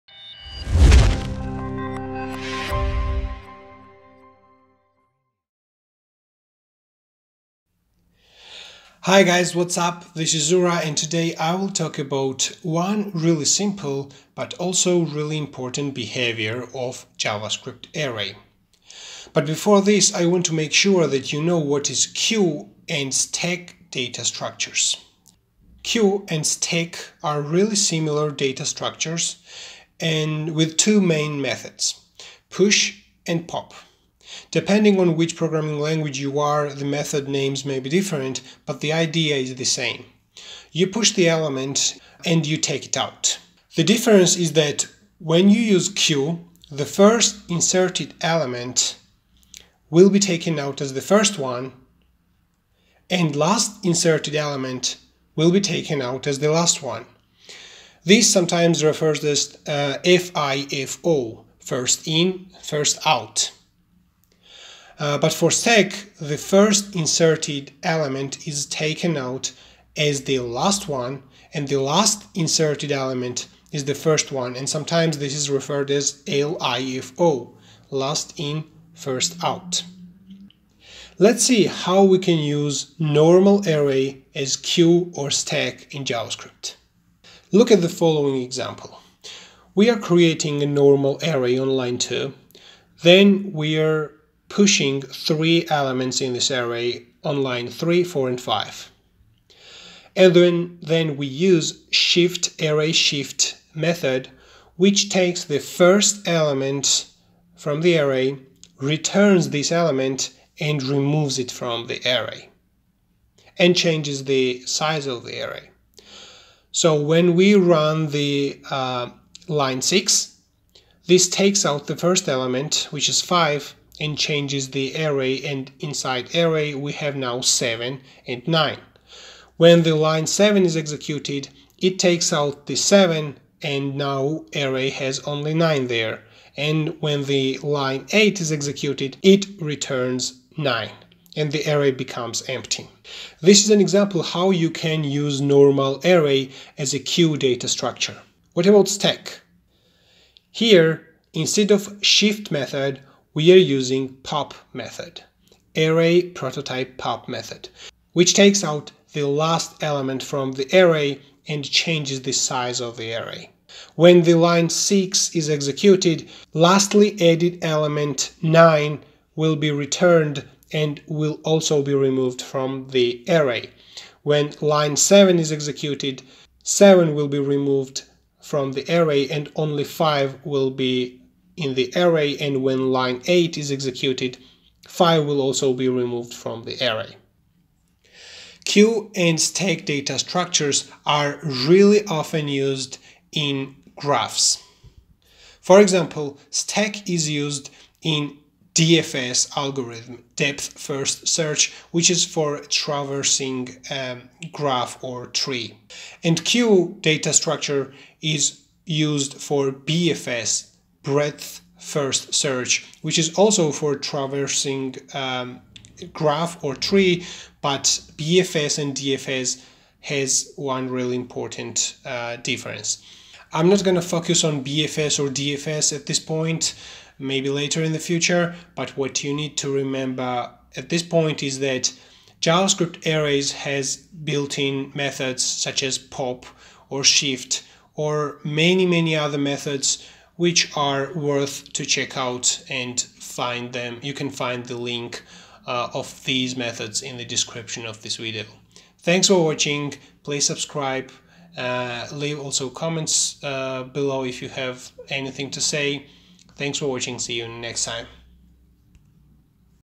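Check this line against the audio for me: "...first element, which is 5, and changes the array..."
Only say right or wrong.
right.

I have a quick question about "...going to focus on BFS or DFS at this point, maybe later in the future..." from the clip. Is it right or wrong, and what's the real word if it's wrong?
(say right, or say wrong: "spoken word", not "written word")
right.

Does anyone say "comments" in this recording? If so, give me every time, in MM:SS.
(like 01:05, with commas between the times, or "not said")
04:12.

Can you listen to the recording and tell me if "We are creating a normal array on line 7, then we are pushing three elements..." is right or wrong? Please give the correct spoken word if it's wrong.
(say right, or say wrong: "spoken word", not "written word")
wrong: "2", not "7".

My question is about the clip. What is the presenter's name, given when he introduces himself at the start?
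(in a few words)
Zura.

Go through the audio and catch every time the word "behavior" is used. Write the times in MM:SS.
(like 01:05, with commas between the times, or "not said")
00:15.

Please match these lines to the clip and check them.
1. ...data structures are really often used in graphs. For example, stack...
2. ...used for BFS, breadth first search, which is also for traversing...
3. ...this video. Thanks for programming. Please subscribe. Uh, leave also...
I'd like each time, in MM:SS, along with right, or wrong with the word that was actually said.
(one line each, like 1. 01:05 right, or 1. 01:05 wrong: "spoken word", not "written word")
1. 03:09 right
2. 03:28 right
3. 04:08 wrong: "watching", not "programming".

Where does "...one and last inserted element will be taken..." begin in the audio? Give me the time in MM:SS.
00:51.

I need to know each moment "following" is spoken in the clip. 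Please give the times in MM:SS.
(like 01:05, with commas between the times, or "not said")
01:27.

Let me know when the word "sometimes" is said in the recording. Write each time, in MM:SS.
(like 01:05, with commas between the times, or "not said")
00:58, 01:14.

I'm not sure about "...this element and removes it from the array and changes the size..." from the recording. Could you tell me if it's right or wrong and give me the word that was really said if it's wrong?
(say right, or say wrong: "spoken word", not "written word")
right.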